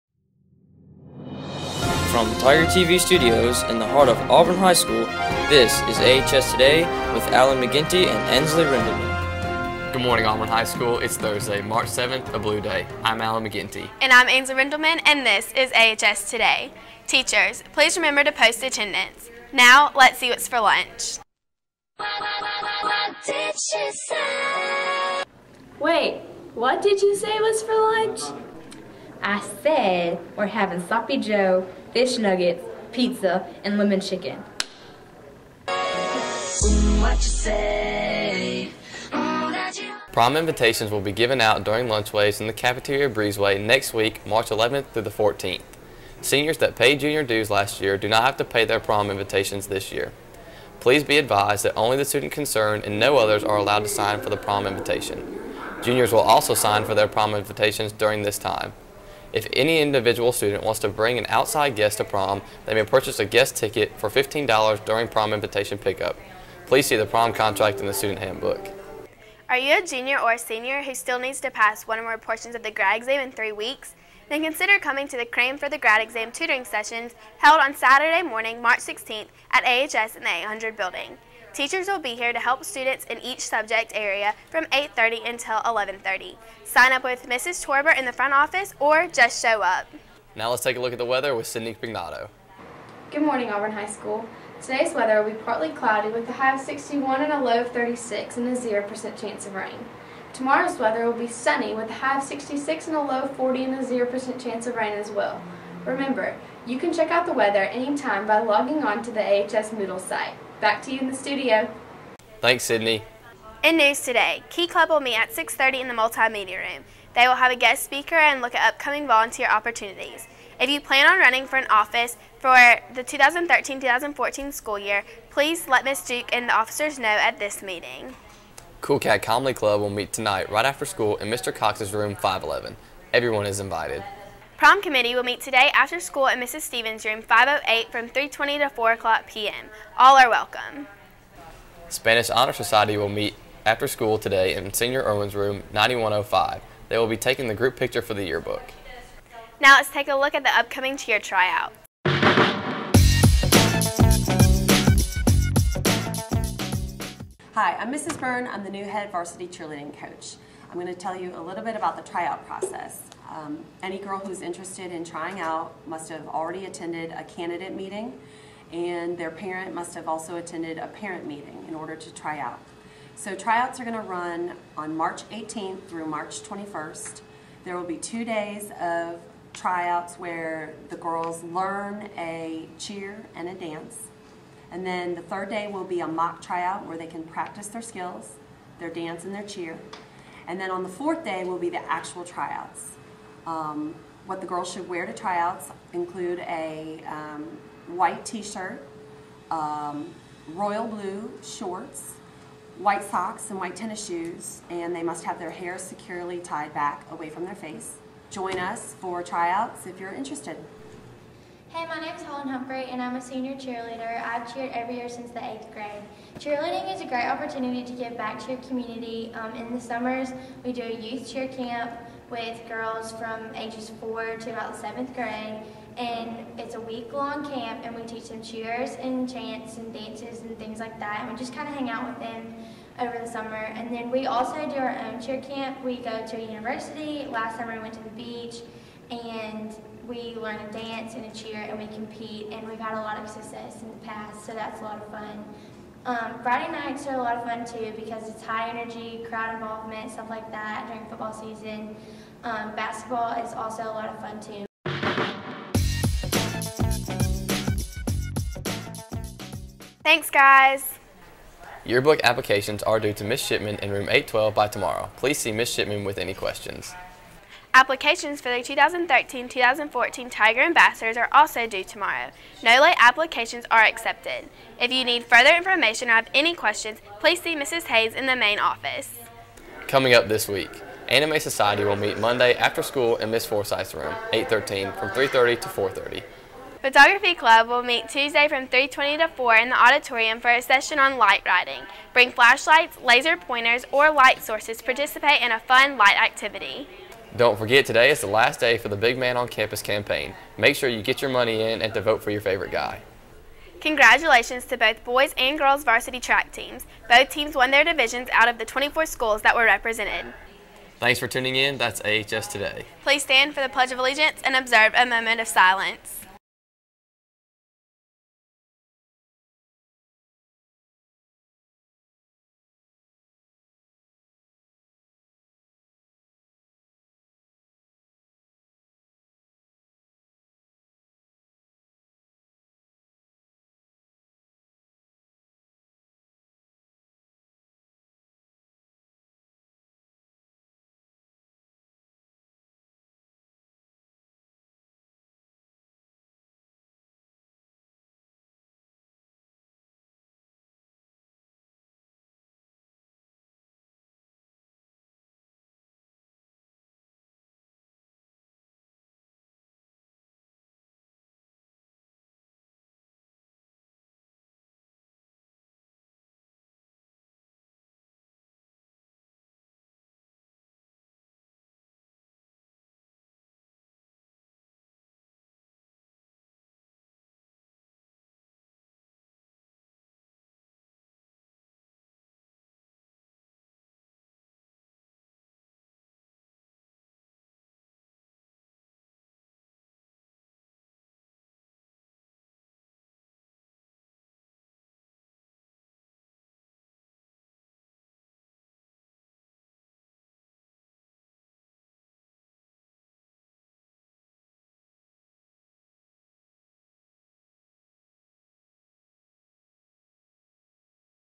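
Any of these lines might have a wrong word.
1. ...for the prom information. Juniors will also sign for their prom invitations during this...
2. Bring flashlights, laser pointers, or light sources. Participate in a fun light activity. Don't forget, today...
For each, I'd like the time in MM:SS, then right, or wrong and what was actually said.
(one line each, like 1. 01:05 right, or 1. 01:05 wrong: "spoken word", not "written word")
1. 00:54 wrong: "invitation", not "information"
2. 04:52 right.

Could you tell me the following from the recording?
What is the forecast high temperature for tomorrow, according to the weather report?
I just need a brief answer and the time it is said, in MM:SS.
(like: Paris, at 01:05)
66, at 01:42.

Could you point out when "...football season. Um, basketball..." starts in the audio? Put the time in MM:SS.
04:11.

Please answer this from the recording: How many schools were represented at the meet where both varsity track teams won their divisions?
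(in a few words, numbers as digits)
24.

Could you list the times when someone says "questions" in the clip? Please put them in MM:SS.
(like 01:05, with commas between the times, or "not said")
04:26, 04:36.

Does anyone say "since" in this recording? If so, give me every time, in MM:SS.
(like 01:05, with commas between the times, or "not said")
03:35.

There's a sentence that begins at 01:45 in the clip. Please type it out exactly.
Remember, you can check out the weather anytime by logging on to the AHS Moodle site.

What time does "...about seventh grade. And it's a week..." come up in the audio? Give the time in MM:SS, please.
03:44.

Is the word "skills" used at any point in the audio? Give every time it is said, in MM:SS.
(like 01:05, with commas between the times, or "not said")
03:07.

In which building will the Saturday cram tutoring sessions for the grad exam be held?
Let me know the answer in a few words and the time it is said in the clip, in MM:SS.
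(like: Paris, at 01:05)
800 building, at 01:20.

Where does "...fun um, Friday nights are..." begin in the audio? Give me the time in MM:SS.
04:05.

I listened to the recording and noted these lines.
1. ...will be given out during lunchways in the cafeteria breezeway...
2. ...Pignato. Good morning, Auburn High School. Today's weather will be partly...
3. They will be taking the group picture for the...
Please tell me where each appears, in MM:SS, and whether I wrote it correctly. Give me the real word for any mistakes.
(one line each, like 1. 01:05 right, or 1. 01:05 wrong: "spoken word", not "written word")
1. 00:40 right
2. 01:31 right
3. 02:26 right.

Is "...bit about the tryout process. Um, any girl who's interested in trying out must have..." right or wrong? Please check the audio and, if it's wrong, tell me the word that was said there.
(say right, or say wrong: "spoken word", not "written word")
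right.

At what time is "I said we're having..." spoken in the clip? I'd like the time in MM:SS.
00:29.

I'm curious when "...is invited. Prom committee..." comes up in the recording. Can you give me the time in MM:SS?
02:13.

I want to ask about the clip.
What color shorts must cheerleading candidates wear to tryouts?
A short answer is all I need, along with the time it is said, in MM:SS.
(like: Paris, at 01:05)
royal blue, at 03:20.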